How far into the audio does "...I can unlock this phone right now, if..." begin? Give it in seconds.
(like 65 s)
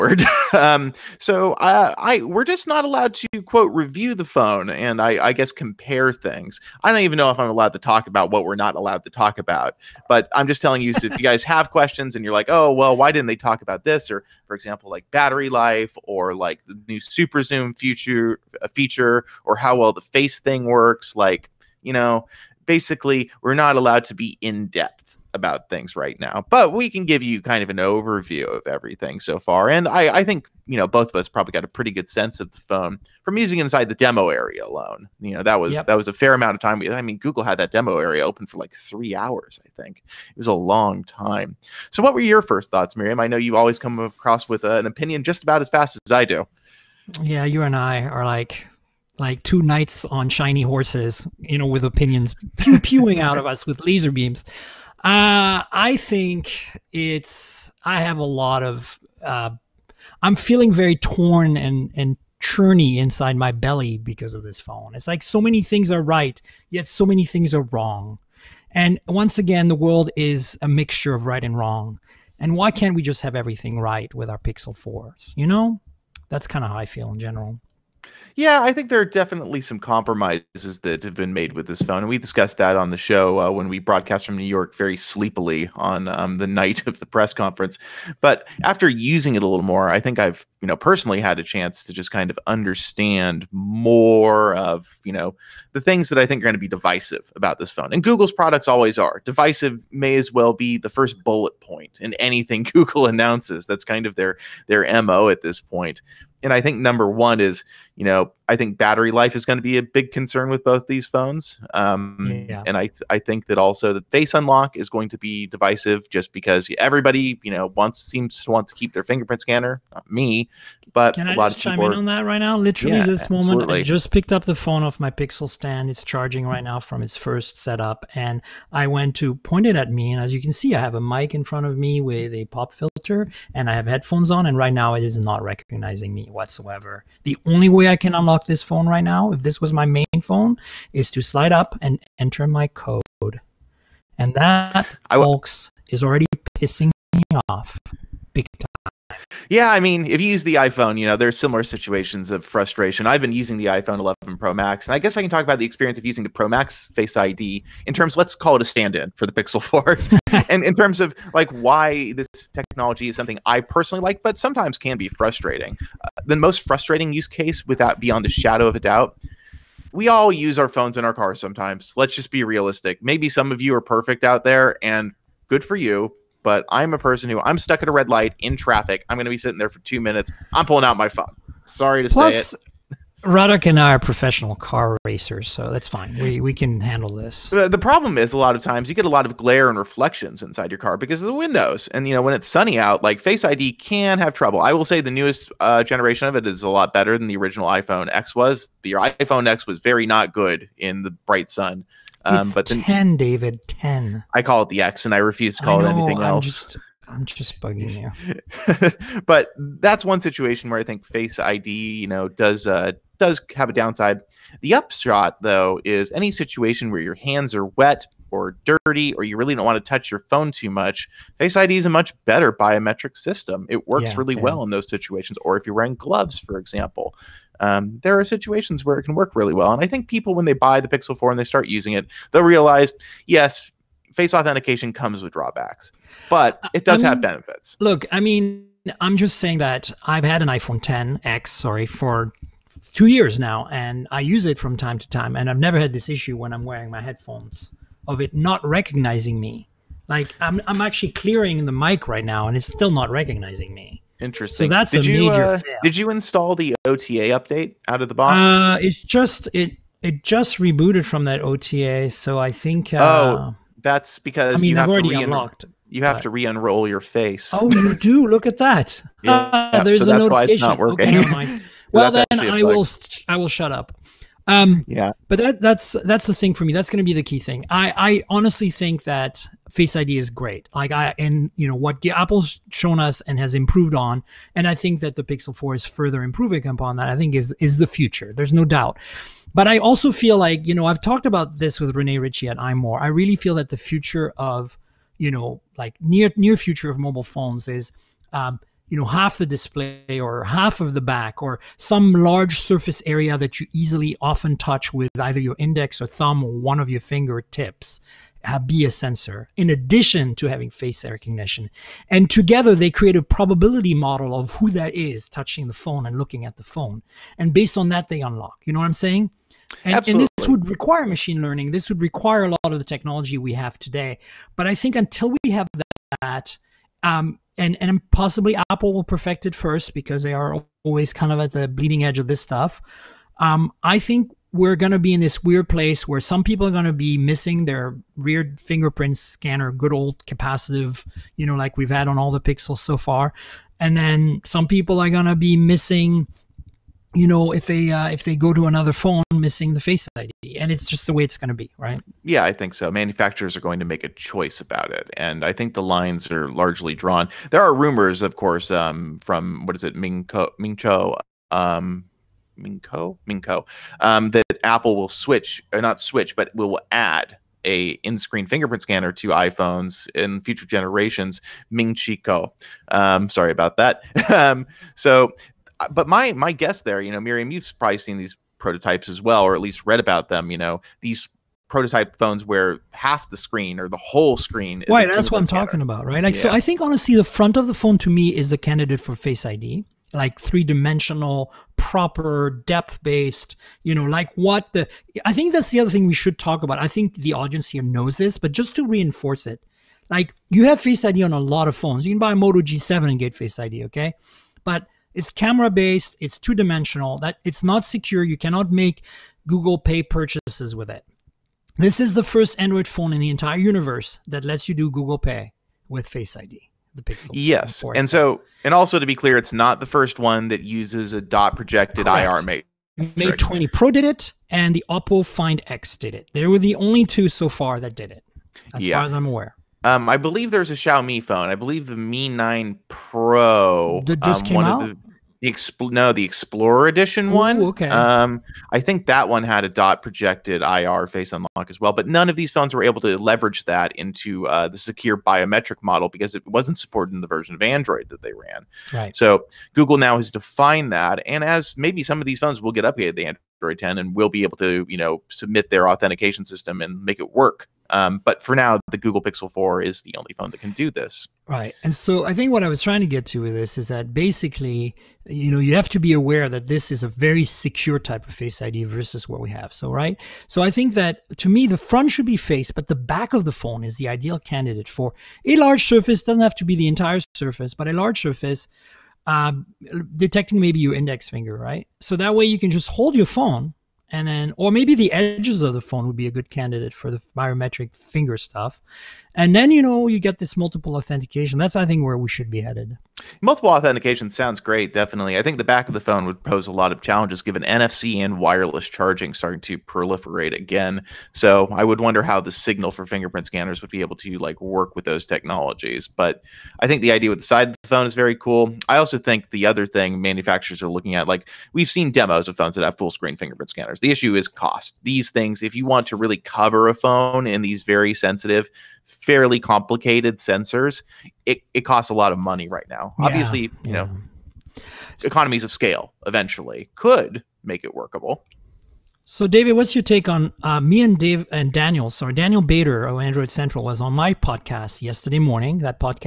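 137 s.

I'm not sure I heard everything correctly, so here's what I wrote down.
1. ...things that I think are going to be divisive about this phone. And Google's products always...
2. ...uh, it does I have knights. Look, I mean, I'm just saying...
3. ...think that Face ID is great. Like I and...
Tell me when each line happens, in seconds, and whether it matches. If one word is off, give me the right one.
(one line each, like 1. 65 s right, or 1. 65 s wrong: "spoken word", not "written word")
1. 95 s right
2. 236 s wrong: "benefits", not "knights"
3. 278 s right.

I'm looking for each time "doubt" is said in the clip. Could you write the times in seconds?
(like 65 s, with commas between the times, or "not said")
168 s, 288 s.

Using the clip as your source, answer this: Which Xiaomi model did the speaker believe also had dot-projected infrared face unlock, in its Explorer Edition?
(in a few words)
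Mi 9 Pro.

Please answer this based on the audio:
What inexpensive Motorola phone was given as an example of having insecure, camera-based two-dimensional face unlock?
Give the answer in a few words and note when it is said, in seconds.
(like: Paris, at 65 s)
Moto G7, at 402 s.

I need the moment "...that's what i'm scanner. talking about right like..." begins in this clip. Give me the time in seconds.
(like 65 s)
385 s.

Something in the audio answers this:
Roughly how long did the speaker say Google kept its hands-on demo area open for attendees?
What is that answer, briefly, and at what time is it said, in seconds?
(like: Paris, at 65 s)
3 hours, at 38 s.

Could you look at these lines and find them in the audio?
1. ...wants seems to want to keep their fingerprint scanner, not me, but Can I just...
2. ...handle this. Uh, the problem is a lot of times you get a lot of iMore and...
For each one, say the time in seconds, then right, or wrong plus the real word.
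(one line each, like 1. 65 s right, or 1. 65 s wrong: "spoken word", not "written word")
1. 117 s right
2. 186 s wrong: "glare", not "iMore".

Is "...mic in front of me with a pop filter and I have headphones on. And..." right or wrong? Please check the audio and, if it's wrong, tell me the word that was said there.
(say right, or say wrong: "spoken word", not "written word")
right.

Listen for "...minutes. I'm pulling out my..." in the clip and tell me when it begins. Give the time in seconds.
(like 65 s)
179 s.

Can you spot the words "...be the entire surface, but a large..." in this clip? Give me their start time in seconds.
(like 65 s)
476 s.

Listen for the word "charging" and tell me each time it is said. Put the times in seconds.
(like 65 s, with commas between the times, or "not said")
126 s, 498 s.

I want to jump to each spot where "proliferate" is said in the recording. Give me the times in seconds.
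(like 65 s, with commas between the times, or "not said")
499 s.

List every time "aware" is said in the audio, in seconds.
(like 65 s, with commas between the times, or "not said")
429 s, 466 s.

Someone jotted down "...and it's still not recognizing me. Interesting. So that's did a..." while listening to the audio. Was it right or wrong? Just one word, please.
right.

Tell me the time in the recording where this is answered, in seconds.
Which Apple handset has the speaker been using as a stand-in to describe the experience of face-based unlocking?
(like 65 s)
153 s.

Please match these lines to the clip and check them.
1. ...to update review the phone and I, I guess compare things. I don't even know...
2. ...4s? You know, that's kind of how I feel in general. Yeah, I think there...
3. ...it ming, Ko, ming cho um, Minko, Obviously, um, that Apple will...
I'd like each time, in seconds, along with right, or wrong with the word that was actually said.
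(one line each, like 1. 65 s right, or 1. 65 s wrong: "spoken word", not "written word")
1. 3 s wrong: "quote", not "update"
2. 74 s right
3. 359 s wrong: "Minko", not "Obviously".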